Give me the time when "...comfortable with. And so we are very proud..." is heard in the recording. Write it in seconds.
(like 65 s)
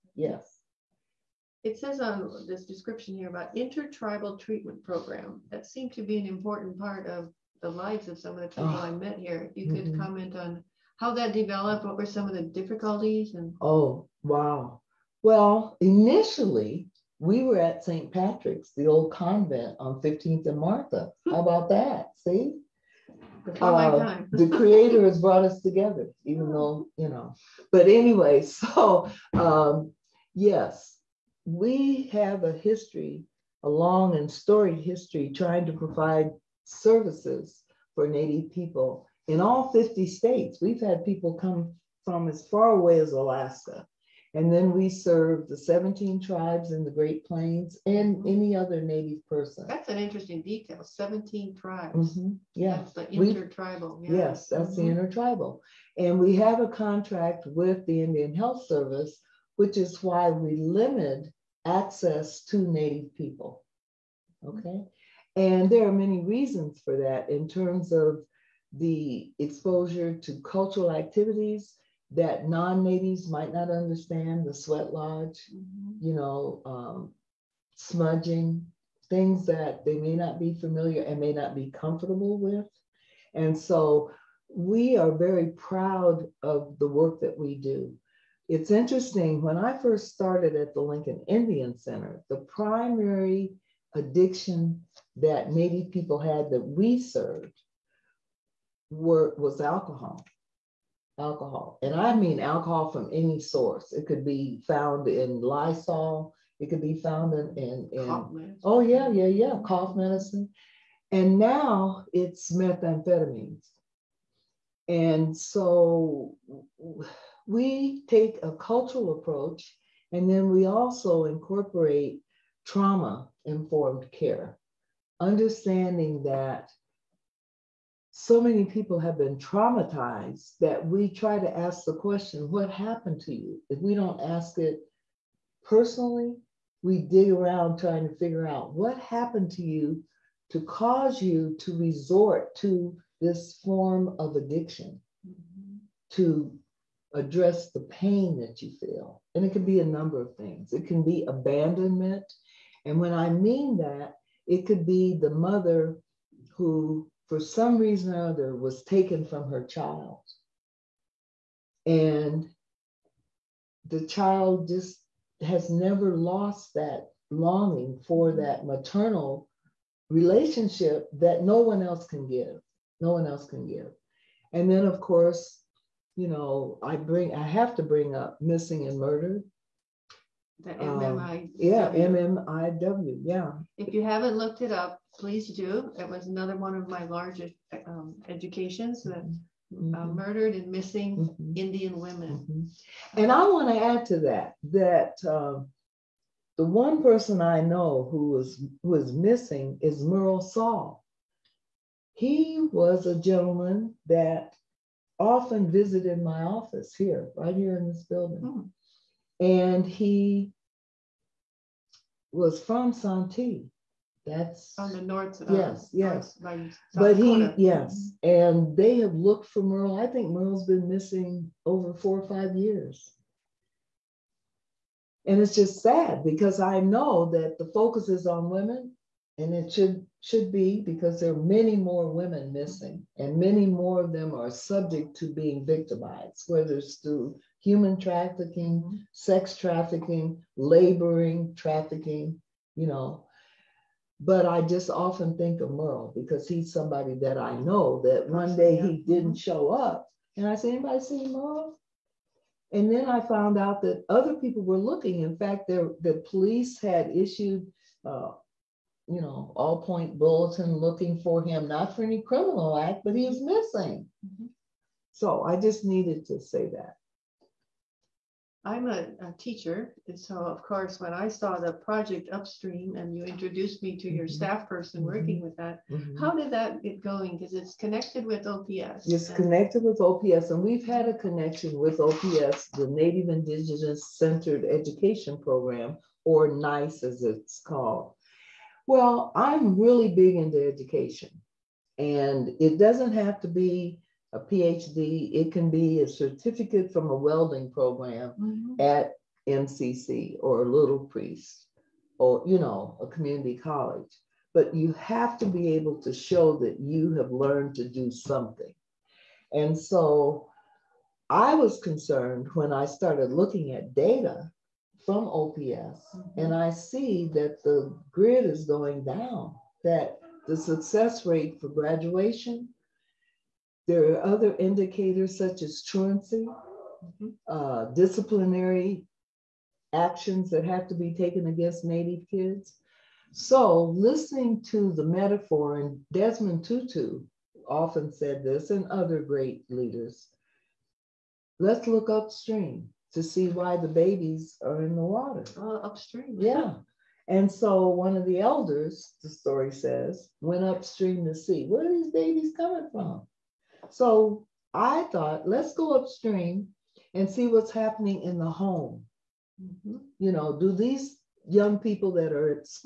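81 s.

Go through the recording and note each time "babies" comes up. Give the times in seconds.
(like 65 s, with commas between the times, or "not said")
343 s, 352 s.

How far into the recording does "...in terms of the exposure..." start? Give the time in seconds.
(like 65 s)
67 s.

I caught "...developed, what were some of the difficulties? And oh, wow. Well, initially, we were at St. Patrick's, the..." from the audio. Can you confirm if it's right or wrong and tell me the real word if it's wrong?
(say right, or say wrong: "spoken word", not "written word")
right.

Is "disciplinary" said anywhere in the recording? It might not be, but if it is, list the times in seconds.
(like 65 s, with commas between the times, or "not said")
327 s.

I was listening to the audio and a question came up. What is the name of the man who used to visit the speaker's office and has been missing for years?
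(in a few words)
Merle Saul.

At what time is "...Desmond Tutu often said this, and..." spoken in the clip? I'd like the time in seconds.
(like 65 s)
336 s.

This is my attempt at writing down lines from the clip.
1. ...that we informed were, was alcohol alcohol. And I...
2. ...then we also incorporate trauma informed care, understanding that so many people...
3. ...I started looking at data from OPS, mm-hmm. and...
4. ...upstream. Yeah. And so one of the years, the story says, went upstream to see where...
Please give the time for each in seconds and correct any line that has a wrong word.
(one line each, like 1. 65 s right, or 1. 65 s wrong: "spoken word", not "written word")
1. 96 s wrong: "served", not "informed"
2. 120 s right
3. 312 s right
4. 345 s wrong: "elders", not "years".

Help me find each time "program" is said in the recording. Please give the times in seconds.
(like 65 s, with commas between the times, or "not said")
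4 s, 285 s, 297 s.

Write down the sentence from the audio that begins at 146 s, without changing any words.
to address the pain that you feel.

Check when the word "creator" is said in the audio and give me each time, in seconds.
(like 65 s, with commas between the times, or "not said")
24 s.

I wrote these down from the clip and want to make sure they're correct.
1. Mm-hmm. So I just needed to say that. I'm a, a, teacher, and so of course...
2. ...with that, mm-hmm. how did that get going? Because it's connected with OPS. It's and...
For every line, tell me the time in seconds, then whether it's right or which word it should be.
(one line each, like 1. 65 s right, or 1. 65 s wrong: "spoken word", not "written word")
1. 264 s right
2. 275 s right.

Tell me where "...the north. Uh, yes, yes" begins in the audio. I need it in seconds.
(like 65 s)
214 s.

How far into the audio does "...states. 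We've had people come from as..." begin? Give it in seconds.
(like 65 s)
40 s.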